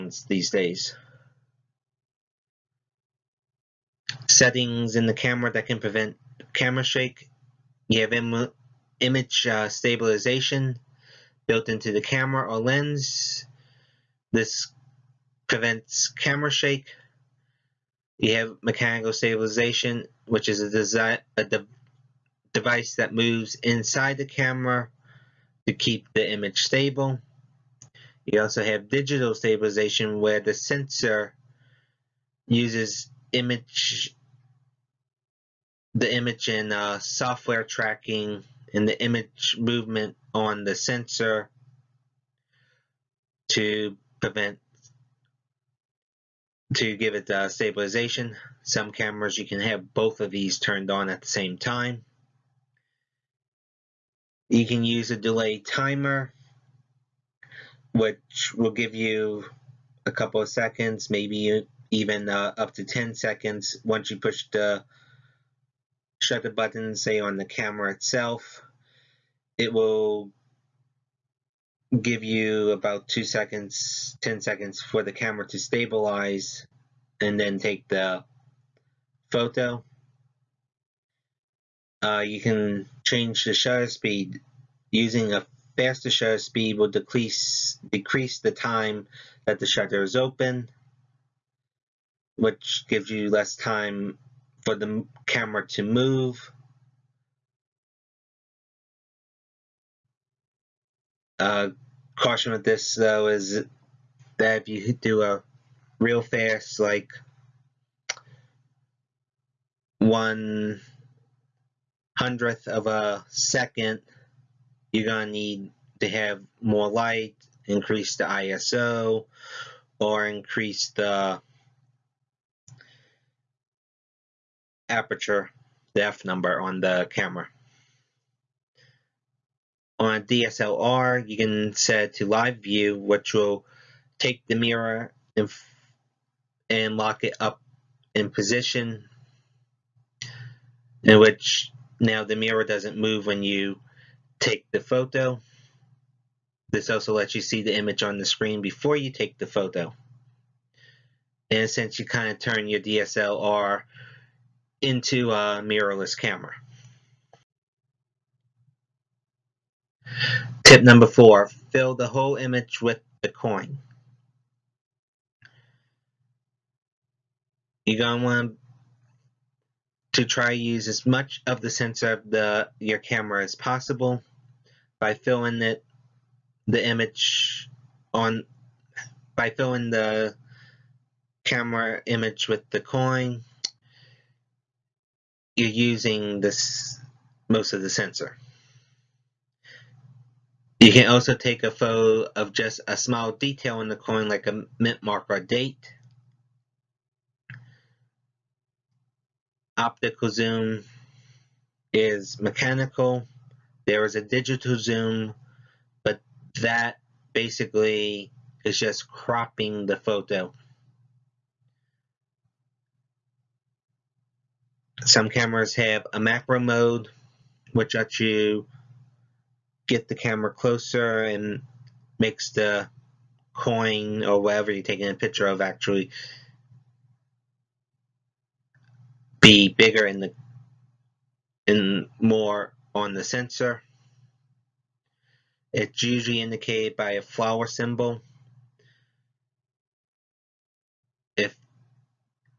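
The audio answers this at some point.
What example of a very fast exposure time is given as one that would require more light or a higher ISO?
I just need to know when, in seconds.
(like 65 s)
109 s.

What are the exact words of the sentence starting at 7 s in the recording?
You have Im image uh, stabilization, built into the camera or lens.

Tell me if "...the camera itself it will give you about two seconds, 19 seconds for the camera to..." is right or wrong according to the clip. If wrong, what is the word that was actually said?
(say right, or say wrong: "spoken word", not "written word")
wrong: "10", not "19".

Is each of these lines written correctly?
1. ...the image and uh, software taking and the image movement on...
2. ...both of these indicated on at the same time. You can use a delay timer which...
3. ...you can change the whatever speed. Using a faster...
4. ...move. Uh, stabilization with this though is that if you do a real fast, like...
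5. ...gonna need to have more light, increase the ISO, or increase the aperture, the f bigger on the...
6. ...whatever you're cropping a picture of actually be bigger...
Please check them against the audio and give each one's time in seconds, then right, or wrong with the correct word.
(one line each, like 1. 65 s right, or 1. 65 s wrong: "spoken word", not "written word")
1. 35 s wrong: "tracking", not "taking"
2. 49 s wrong: "turned", not "indicated"
3. 82 s wrong: "shutter", not "whatever"
4. 95 s wrong: "caution", not "stabilization"
5. 115 s wrong: "number", not "bigger"
6. 224 s wrong: "taking", not "cropping".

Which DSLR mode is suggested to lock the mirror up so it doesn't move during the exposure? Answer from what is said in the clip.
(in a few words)
Live view.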